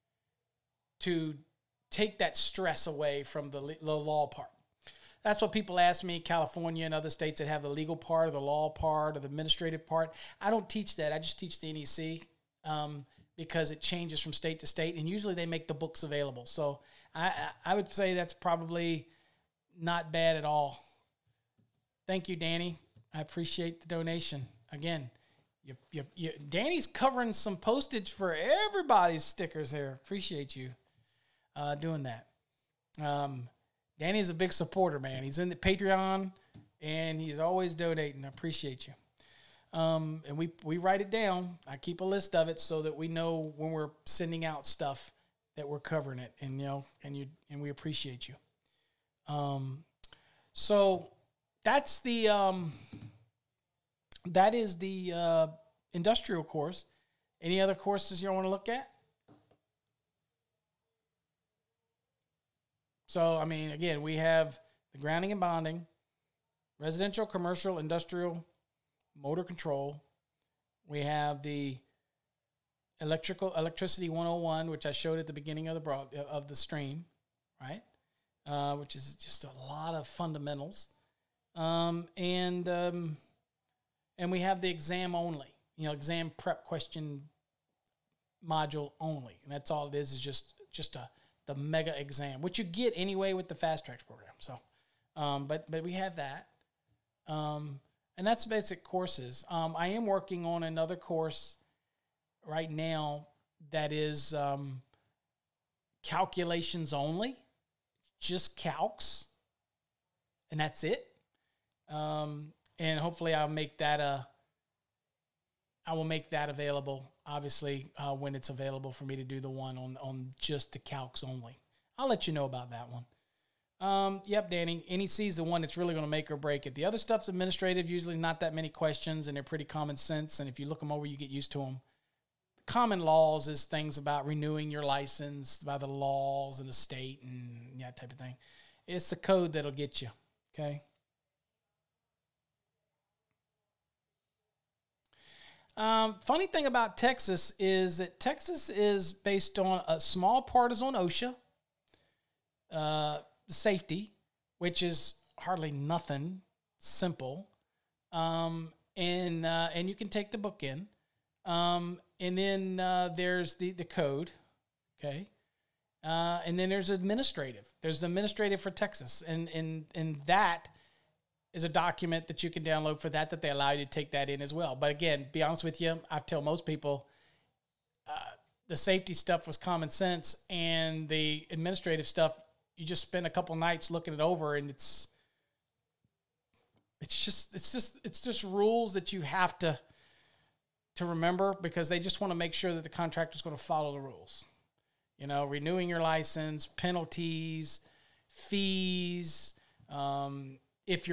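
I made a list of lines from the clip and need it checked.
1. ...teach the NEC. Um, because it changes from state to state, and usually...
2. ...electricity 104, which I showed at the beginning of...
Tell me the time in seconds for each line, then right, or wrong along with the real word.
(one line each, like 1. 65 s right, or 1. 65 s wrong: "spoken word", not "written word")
1. 11 s right
2. 73 s wrong: "101", not "104".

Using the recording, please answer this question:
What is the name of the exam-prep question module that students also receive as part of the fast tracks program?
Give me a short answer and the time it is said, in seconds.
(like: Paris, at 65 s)
mega exam, at 91 s.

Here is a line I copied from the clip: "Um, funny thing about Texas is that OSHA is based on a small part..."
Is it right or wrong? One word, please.
wrong.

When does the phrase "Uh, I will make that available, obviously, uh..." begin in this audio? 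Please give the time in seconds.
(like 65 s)
114 s.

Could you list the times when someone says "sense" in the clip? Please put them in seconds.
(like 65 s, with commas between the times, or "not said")
129 s, 179 s.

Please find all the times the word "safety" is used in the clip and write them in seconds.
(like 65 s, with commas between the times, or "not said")
153 s, 178 s.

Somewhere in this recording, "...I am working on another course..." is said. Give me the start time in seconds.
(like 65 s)
99 s.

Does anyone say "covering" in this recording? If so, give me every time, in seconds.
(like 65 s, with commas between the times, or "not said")
26 s, 45 s.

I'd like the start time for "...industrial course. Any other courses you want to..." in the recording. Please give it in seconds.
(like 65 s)
55 s.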